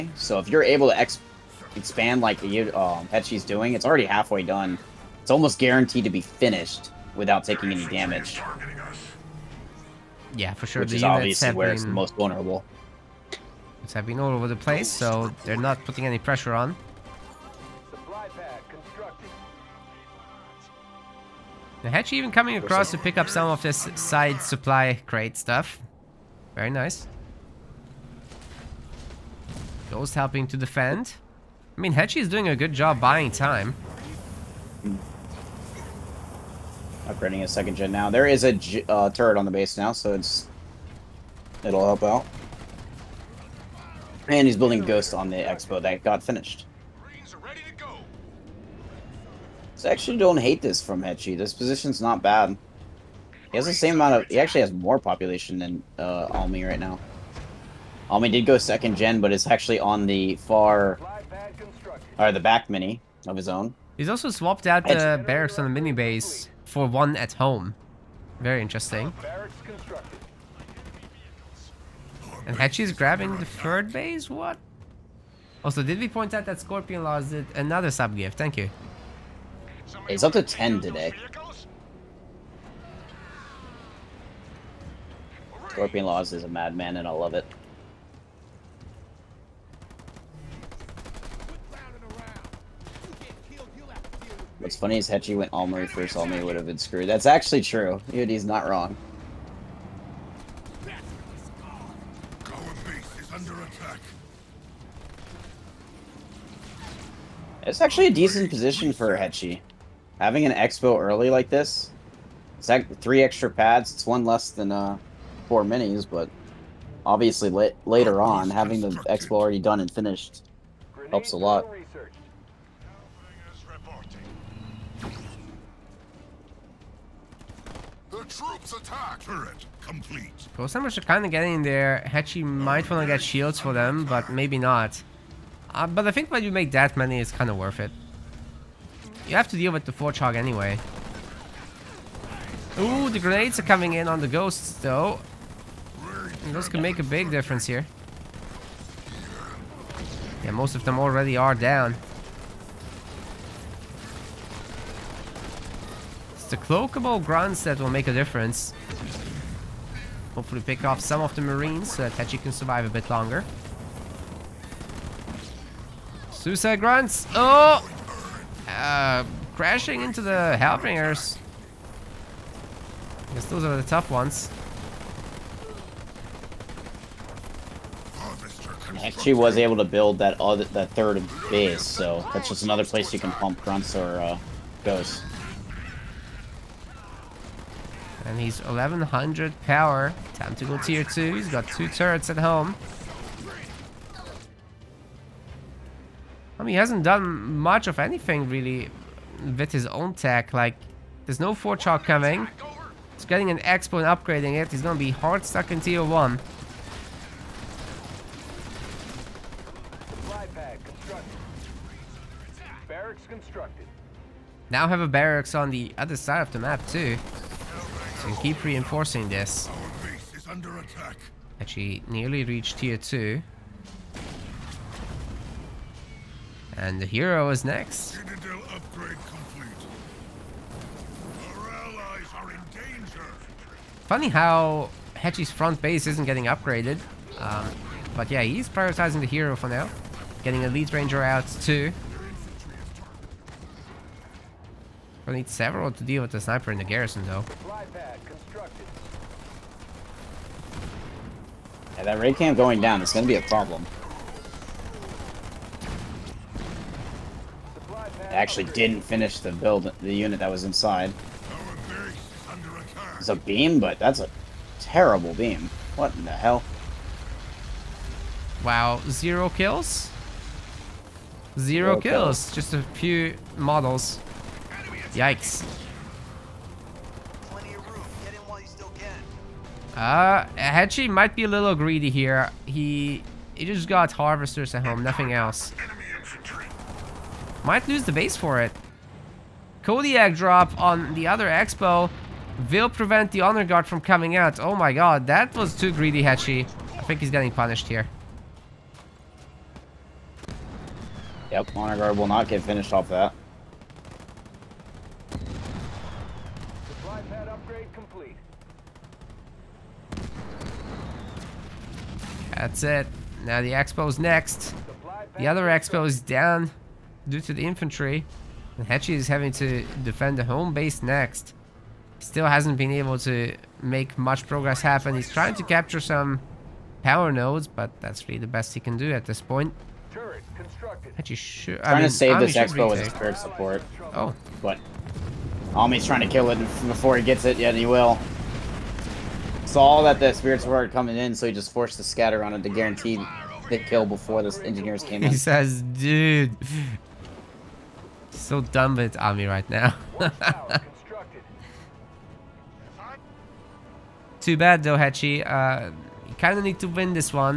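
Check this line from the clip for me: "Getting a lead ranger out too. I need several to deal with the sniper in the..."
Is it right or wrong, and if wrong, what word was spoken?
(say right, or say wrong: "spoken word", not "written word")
right.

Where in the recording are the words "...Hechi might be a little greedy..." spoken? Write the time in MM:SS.
04:40.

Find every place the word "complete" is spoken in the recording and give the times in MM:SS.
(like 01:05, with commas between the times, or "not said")
02:09, 05:07.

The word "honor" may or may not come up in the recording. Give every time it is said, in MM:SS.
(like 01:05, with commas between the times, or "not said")
04:53, 05:01.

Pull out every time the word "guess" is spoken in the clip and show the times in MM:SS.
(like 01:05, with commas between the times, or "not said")
02:53.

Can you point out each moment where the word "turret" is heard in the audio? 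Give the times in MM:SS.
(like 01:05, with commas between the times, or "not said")
00:39, 02:09, 03:11.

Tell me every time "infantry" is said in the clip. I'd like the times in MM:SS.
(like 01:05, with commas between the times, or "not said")
05:17.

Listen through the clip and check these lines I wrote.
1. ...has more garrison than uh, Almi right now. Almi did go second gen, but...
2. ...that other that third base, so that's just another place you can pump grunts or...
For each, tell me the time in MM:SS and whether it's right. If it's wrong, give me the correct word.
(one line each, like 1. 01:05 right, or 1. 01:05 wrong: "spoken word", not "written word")
1. 00:54 wrong: "population", not "garrison"
2. 03:00 right.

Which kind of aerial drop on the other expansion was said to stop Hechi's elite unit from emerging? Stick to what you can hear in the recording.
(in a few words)
Kodiak drop.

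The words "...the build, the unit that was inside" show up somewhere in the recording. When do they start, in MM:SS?
04:19.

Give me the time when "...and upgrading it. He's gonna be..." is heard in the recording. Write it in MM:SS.
03:24.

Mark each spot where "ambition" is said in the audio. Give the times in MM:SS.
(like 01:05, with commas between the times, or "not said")
not said.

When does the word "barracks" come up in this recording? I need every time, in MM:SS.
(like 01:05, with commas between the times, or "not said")
01:05, 03:35.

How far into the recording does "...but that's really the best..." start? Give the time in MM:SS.
05:27.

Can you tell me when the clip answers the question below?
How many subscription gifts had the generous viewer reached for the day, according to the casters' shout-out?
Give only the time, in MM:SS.
01:20.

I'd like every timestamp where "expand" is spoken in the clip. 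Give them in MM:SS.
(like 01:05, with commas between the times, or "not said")
00:01.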